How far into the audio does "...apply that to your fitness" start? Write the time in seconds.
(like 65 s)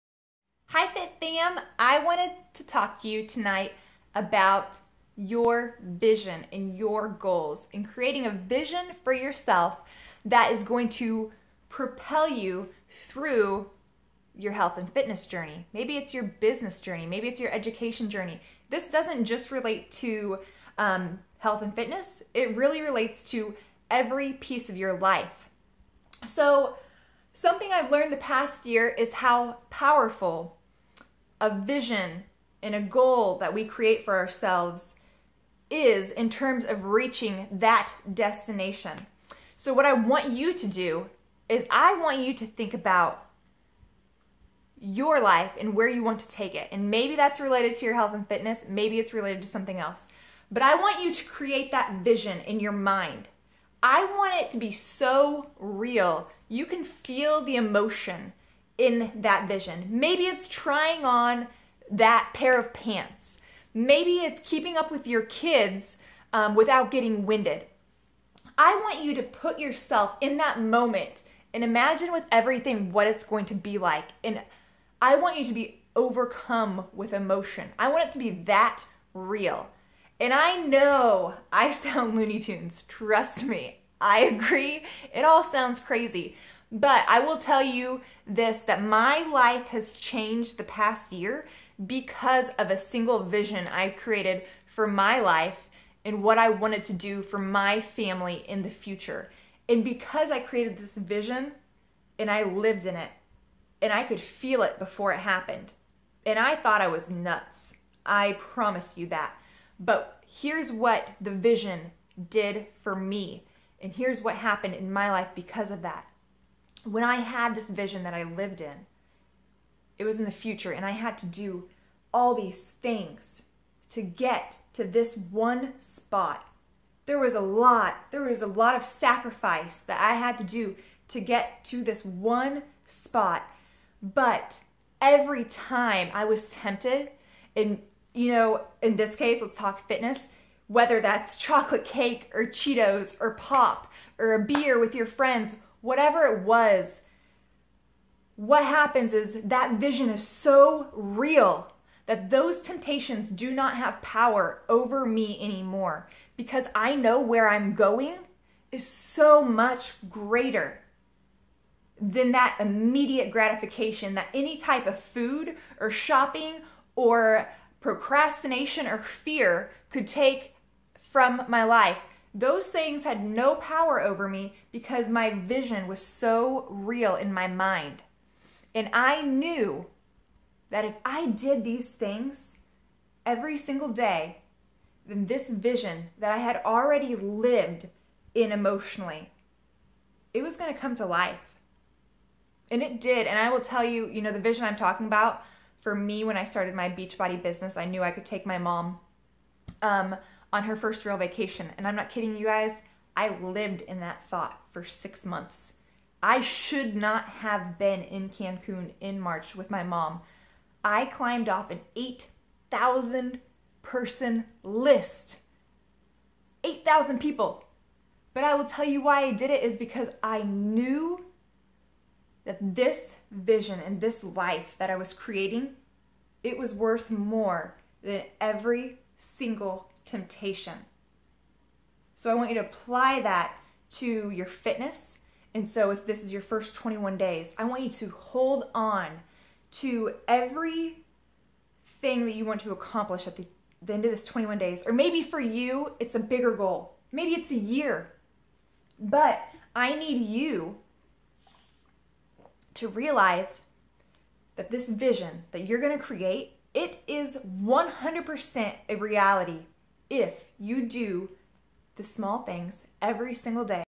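232 s.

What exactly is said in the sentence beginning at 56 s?
You can feel the emotion in that vision.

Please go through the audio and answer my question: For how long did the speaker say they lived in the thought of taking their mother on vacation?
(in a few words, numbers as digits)
6 months.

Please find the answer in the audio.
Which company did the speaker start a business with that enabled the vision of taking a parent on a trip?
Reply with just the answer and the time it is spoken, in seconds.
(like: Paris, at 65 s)
Beachbody, at 196 s.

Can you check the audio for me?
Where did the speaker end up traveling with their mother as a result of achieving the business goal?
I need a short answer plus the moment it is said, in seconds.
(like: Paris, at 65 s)
Cancun, at 208 s.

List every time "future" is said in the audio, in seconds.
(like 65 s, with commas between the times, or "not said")
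98 s, 120 s.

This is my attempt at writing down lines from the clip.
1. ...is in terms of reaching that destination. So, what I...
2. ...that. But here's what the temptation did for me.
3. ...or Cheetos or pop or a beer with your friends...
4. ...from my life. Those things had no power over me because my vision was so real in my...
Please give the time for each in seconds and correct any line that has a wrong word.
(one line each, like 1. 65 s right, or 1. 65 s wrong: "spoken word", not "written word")
1. 35 s right
2. 109 s wrong: "vision", not "temptation"
3. 142 s right
4. 170 s right.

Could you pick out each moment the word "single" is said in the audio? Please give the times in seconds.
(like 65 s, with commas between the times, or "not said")
92 s, 183 s, 229 s, 263 s.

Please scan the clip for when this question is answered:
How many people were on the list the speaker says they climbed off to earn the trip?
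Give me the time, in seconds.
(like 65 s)
216 s.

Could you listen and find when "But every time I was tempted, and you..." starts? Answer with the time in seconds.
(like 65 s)
134 s.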